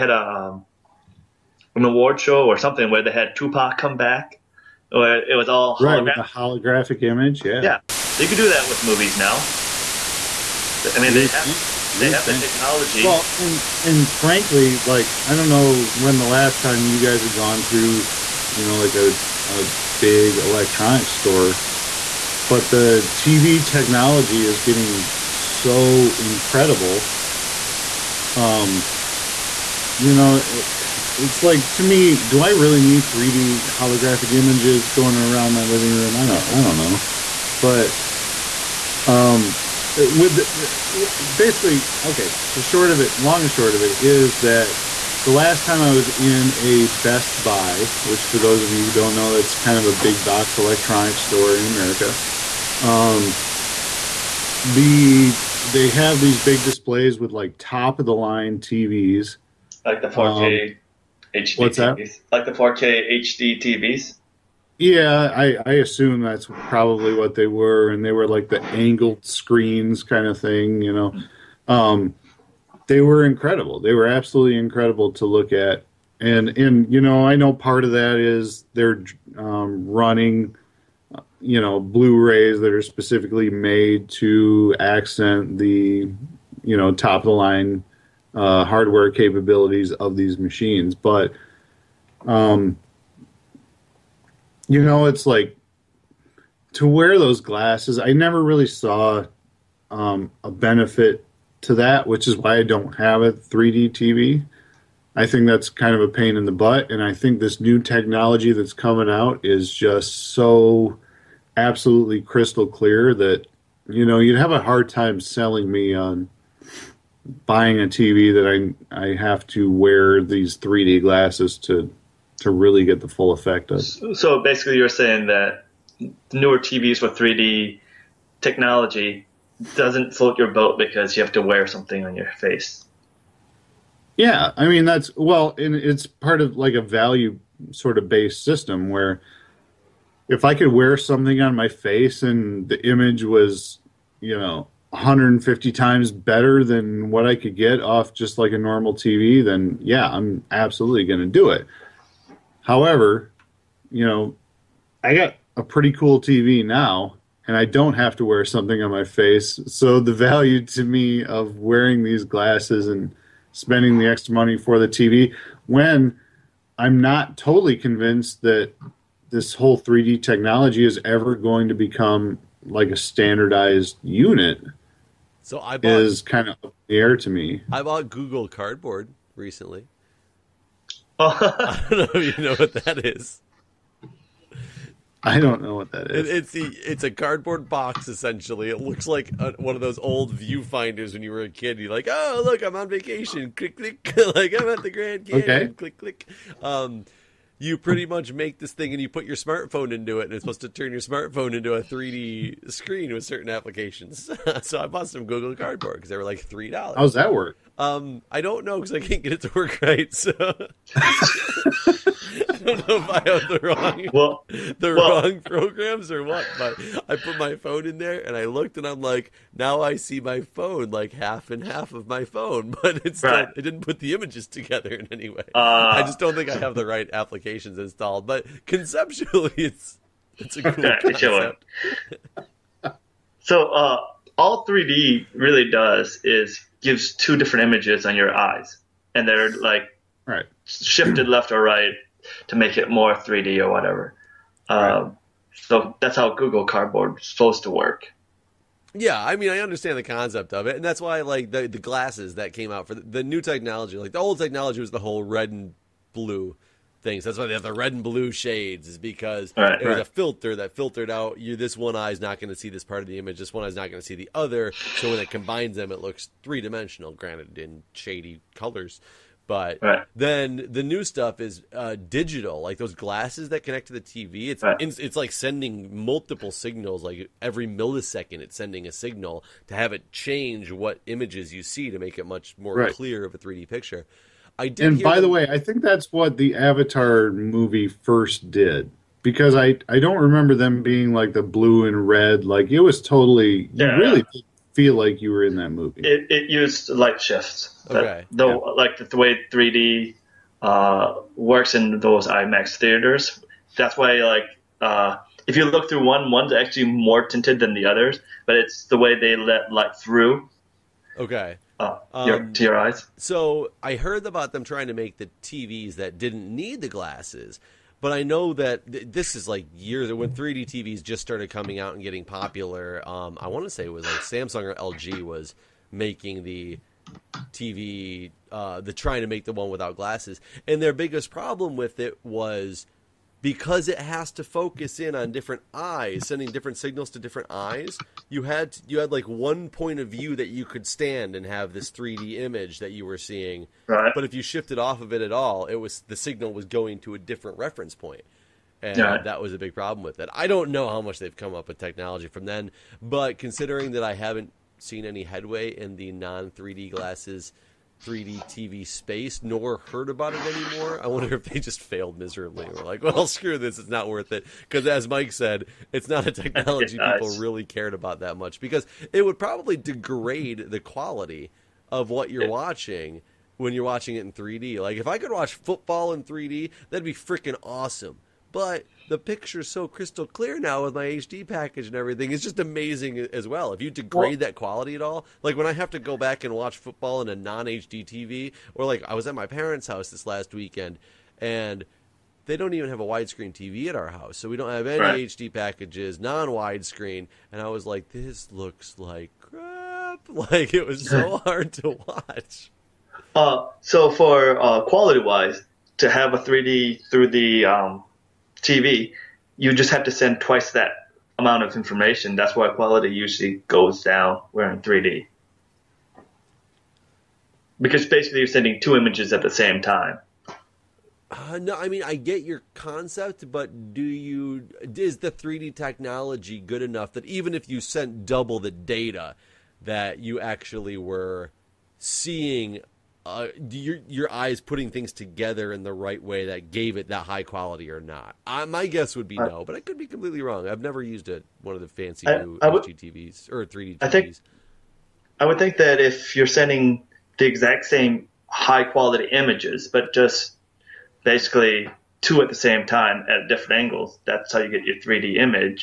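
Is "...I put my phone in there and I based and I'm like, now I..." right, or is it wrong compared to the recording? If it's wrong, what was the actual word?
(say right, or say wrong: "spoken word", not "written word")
wrong: "looked", not "based".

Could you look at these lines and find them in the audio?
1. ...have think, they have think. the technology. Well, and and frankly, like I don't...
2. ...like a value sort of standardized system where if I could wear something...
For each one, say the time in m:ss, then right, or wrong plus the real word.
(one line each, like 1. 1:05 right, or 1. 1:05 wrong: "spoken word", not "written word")
1. 0:11 right
2. 2:16 wrong: "based", not "standardized".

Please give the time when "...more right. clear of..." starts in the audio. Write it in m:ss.
4:42.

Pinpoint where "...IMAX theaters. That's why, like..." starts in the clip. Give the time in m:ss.
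5:02.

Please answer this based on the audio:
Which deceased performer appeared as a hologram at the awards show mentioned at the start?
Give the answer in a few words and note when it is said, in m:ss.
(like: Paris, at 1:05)
Tupac, at 0:03.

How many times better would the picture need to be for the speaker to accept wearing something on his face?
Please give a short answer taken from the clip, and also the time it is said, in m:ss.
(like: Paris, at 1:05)
150, at 2:24.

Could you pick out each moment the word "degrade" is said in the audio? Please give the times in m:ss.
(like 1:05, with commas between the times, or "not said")
6:09, 6:23.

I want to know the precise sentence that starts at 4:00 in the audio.
shifted left or right to make it more 3D or whatever.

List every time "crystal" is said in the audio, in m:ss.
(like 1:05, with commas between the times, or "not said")
1:52, 6:19.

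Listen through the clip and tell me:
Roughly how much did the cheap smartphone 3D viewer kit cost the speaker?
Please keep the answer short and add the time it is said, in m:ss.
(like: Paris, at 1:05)
3 dollars, at 3:26.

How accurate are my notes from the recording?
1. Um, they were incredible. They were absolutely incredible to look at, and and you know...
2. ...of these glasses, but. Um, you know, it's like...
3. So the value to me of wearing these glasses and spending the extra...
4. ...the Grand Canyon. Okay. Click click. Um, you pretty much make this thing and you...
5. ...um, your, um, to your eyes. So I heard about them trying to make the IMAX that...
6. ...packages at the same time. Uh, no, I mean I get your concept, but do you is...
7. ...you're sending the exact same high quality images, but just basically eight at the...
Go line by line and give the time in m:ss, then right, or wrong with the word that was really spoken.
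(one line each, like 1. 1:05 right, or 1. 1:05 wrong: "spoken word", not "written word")
1. 1:11 right
2. 1:29 wrong: "machines", not "glasses"
3. 2:39 right
4. 3:14 right
5. 5:12 wrong: "TVs", not "IMAX"
6. 6:58 wrong: "images", not "packages"
7. 7:26 wrong: "two", not "eight".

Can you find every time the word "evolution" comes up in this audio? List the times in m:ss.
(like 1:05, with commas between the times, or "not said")
not said.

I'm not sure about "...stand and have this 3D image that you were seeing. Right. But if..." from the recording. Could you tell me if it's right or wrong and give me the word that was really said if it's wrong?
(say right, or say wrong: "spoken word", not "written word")
right.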